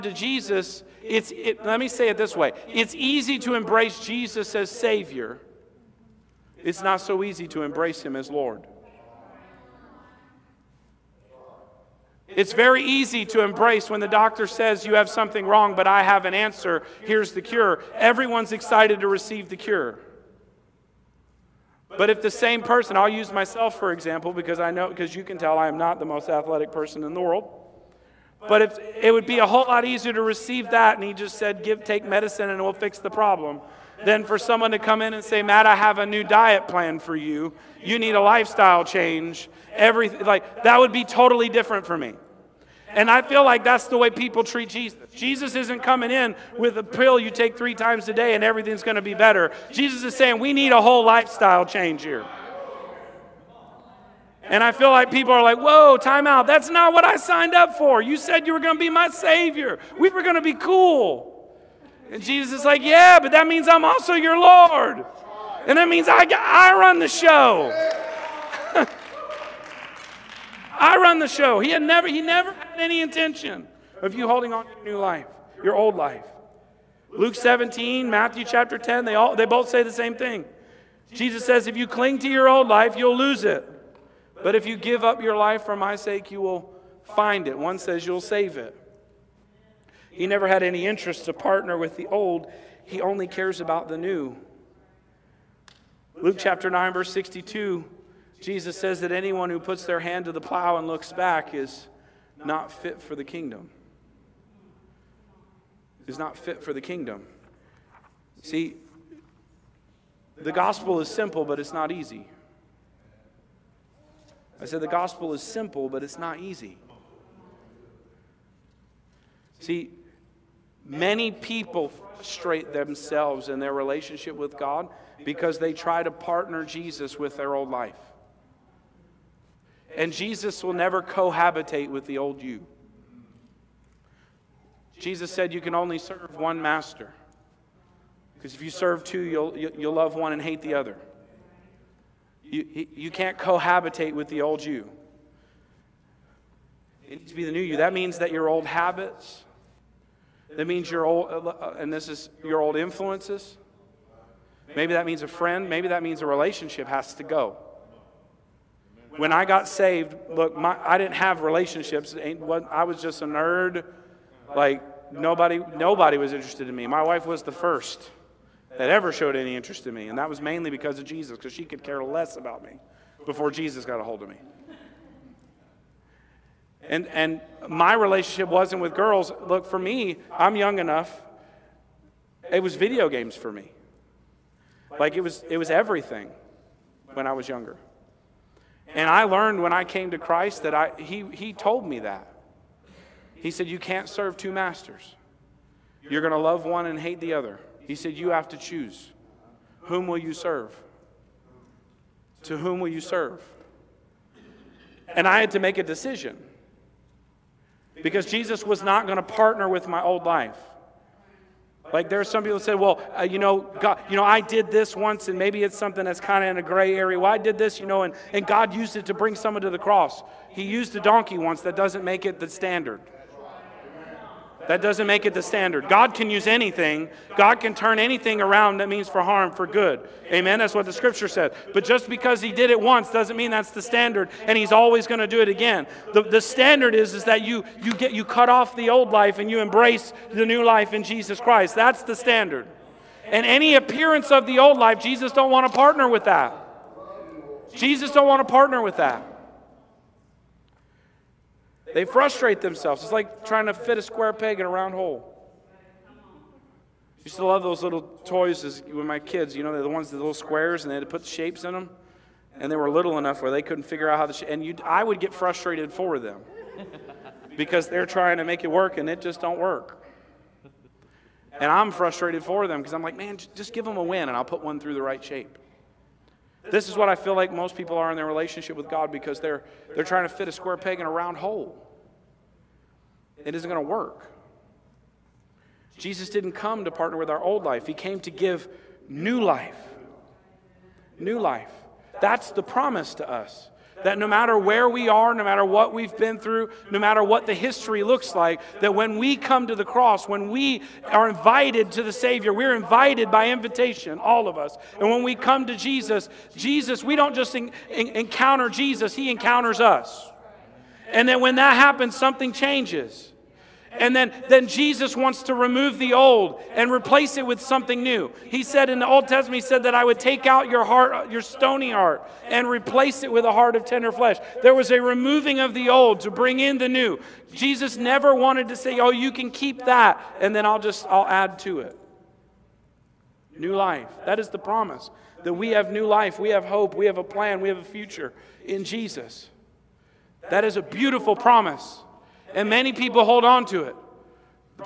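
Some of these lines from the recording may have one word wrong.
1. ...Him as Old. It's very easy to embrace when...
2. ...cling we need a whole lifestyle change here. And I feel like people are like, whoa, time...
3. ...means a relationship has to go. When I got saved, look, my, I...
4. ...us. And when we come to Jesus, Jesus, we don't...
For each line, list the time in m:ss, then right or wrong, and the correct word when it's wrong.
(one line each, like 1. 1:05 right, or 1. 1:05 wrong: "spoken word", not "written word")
1. 0:08 wrong: "Lord", not "Old"
2. 0:50 wrong: "saying", not "cling"
3. 2:36 right
4. 5:04 right.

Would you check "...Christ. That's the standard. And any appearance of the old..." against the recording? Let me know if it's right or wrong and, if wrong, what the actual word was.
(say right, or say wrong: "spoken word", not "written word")
right.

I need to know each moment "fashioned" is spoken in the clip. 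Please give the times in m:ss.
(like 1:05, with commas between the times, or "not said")
not said.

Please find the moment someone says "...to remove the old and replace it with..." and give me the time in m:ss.
5:15.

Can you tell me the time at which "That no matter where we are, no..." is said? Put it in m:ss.
4:54.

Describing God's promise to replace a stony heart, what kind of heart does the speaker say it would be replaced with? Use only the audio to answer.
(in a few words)
Tender flesh.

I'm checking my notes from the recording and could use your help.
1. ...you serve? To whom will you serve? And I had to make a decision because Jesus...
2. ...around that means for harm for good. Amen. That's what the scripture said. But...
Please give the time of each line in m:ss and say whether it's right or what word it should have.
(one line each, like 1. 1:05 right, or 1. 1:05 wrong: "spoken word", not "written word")
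1. 3:20 right
2. 3:48 right.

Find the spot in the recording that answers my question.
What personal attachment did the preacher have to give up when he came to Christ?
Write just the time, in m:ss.
3:02.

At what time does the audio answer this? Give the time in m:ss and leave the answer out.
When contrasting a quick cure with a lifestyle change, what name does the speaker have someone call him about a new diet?
0:35.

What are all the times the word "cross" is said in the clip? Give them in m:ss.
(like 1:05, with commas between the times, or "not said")
3:39, 4:59.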